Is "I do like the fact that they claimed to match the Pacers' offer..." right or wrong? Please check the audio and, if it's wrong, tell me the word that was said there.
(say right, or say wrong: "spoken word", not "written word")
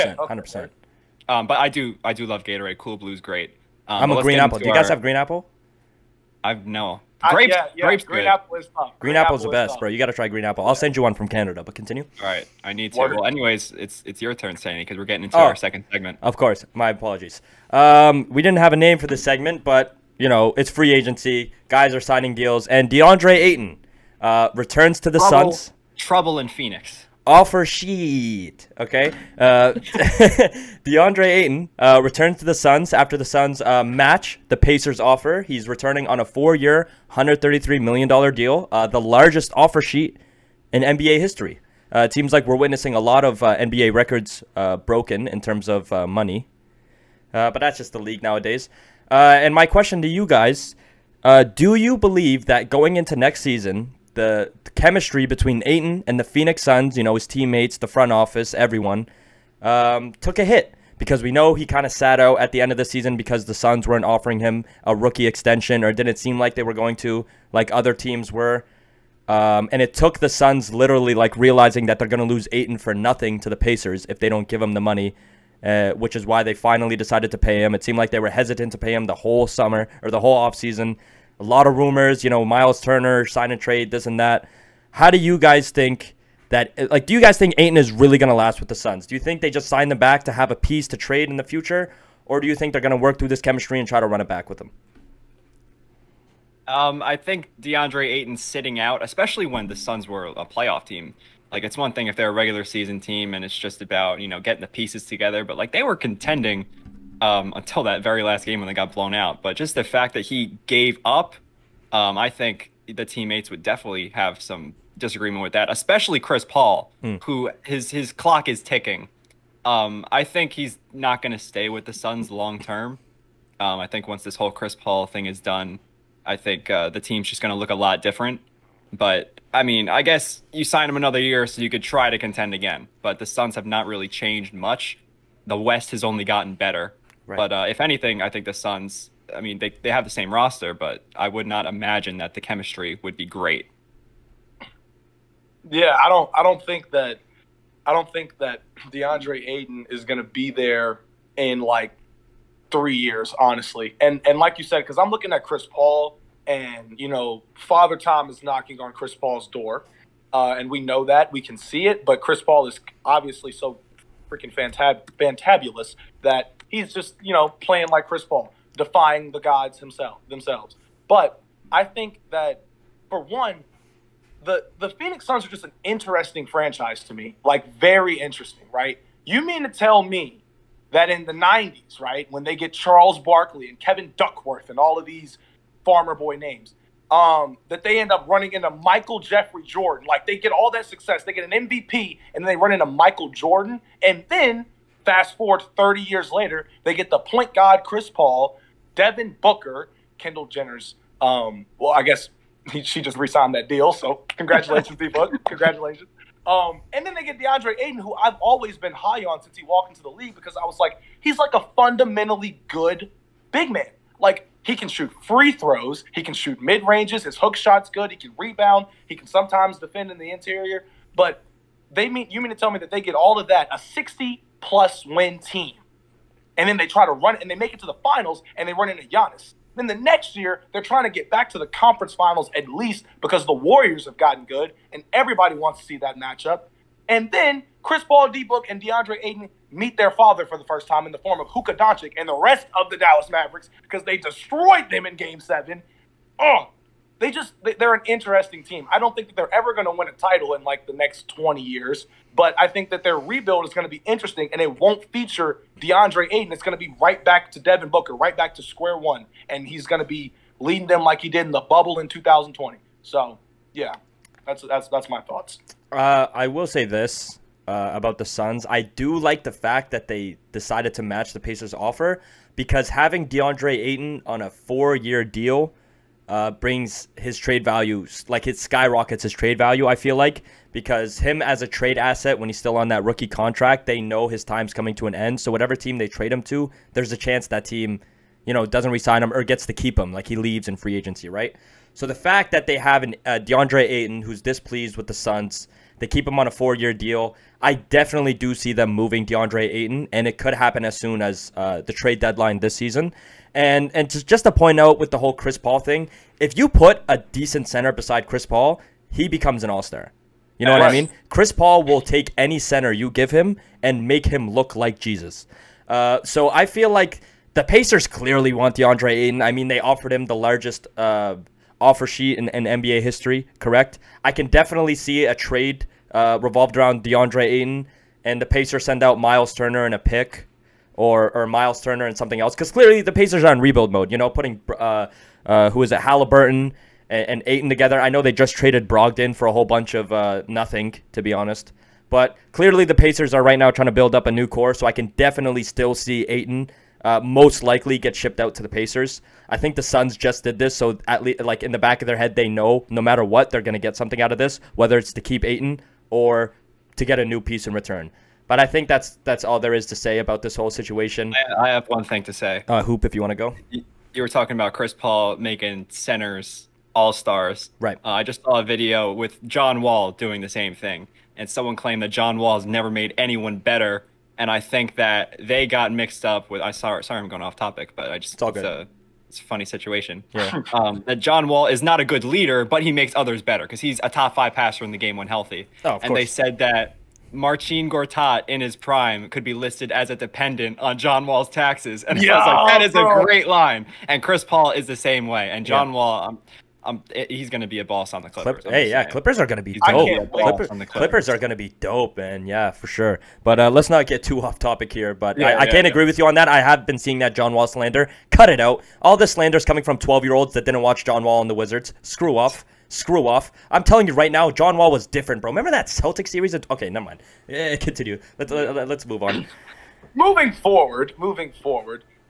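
wrong: "decided", not "claimed".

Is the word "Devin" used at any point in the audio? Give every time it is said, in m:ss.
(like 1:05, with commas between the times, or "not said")
3:18, 4:17.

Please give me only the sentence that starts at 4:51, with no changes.
So the fact that they have an, uh, DeAndre Ayton, who's displeased with the Suns, they keep him on a four-year deal.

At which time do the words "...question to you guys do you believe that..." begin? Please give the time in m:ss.
0:49.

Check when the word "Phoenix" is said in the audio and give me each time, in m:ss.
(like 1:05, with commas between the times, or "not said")
0:26, 0:56, 2:54.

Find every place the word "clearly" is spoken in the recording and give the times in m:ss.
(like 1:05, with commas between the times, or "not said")
5:18, 5:32, 5:42.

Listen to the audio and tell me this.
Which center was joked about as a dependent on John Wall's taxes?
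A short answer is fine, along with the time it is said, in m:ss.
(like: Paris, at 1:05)
Marcin Gortat, at 6:27.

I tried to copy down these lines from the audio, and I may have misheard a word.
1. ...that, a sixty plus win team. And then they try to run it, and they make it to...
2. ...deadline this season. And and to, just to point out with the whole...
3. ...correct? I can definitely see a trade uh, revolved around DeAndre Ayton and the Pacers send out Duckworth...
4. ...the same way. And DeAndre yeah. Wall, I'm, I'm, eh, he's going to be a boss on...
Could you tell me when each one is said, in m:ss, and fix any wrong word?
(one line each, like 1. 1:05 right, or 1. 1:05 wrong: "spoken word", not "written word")
1. 3:43 right
2. 5:02 right
3. 5:23 wrong: "Miles", not "Duckworth"
4. 6:34 wrong: "John", not "DeAndre".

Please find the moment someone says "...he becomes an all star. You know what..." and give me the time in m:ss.
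5:09.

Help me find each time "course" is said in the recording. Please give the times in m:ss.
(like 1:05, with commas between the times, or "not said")
0:16, 6:26.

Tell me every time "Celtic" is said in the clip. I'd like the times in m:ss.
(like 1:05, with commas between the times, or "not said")
6:55.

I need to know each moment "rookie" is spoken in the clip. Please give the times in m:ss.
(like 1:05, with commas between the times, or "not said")
1:04, 4:43.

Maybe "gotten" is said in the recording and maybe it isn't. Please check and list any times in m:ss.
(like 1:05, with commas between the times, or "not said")
2:16, 3:54.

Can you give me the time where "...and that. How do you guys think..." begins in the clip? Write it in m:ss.
1:24.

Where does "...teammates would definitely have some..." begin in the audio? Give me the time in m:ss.
1:53.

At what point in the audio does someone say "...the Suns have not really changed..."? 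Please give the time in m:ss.
2:13.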